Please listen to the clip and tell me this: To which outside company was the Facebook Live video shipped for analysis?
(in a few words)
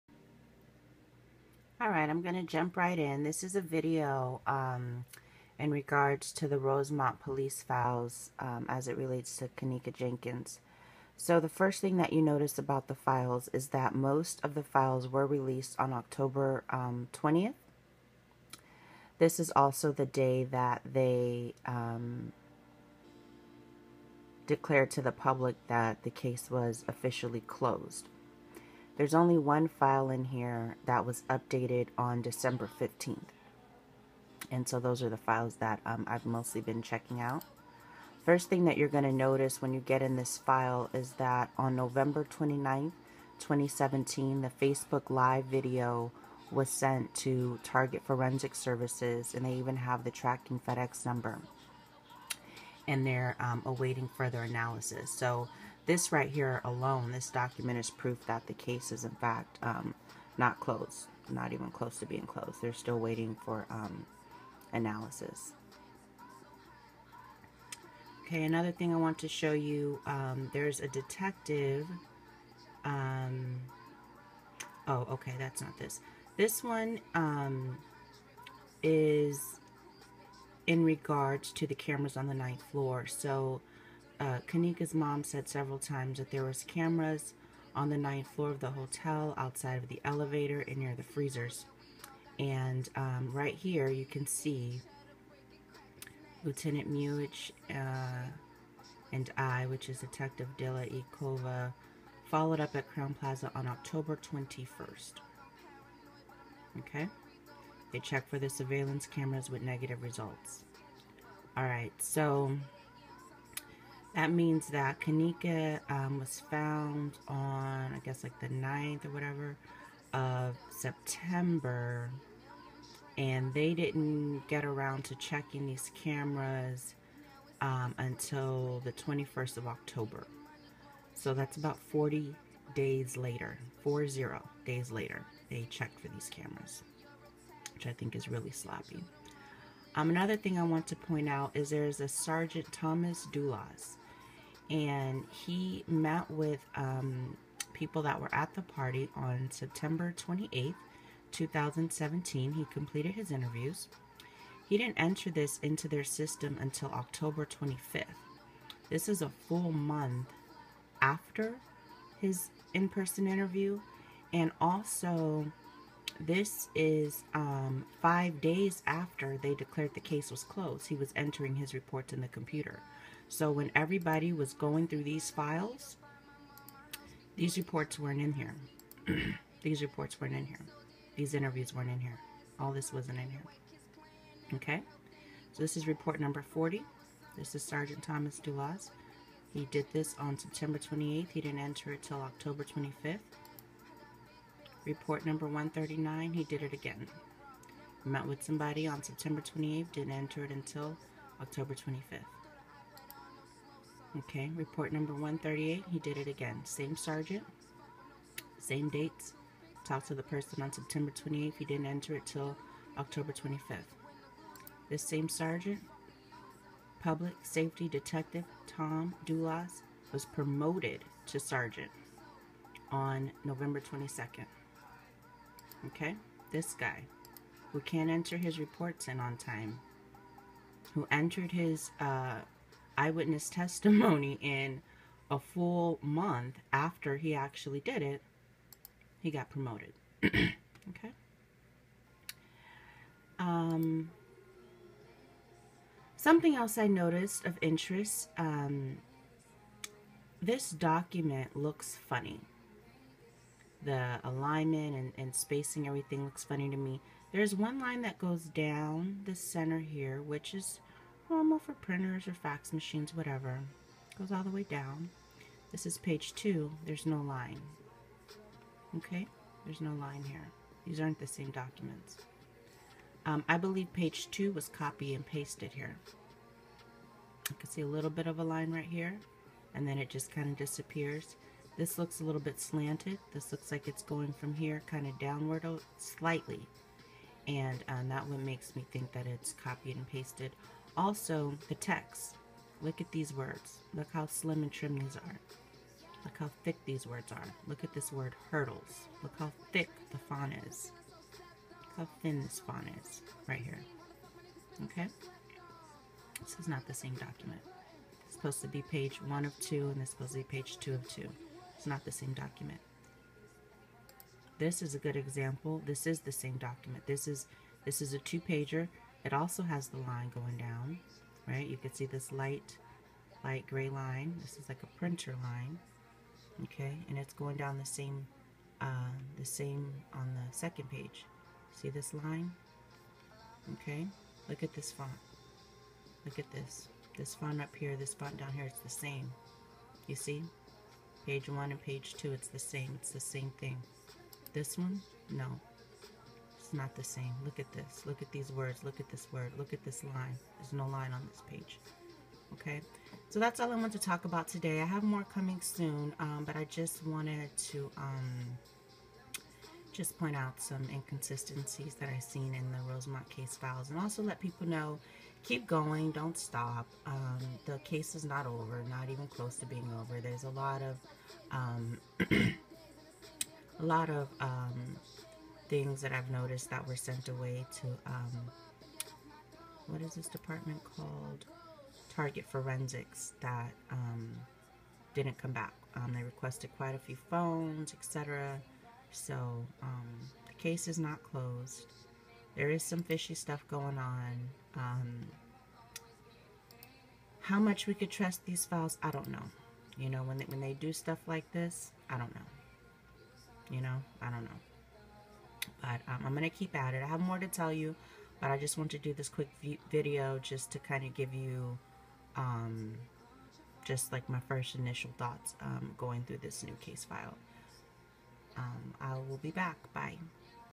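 Target Forensic Services.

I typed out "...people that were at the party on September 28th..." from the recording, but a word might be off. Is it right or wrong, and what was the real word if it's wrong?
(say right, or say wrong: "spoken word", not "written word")
right.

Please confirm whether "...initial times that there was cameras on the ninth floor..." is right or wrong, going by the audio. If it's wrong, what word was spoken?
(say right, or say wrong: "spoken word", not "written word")
wrong: "several", not "initial".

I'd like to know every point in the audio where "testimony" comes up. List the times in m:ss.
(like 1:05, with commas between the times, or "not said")
3:53.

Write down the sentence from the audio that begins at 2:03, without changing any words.
And they didn't get around to checking these cameras um, until the 21st of October.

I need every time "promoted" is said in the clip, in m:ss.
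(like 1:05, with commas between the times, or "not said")
3:40, 3:59.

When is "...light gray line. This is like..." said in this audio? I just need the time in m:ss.
5:23.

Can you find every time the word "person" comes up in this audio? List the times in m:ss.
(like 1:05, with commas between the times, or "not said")
2:42, 3:30.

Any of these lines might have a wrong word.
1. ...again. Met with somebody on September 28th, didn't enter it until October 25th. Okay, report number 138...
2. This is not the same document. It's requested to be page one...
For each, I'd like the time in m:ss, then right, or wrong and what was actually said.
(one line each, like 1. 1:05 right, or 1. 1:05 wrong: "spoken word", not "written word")
1. 3:16 right
2. 5:06 wrong: "supposed", not "requested".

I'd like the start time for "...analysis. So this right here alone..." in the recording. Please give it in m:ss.
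0:54.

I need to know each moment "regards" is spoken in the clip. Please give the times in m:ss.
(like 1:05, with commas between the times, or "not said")
0:05, 1:20.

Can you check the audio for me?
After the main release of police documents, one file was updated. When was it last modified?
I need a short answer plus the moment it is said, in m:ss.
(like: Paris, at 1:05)
December 15, at 0:32.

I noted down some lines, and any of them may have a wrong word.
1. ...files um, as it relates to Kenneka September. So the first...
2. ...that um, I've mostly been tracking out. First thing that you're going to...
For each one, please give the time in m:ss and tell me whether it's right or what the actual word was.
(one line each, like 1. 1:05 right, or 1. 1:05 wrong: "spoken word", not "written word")
1. 0:07 wrong: "Jenkins", not "September"
2. 0:35 wrong: "checking", not "tracking".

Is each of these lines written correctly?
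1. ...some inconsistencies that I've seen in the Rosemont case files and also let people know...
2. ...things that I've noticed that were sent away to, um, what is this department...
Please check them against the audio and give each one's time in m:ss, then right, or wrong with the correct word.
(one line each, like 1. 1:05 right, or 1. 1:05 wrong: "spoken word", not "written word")
1. 6:00 right
2. 6:15 right.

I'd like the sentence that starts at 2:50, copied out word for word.
He was entering his reports in the computer.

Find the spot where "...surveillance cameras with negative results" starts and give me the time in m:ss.
1:48.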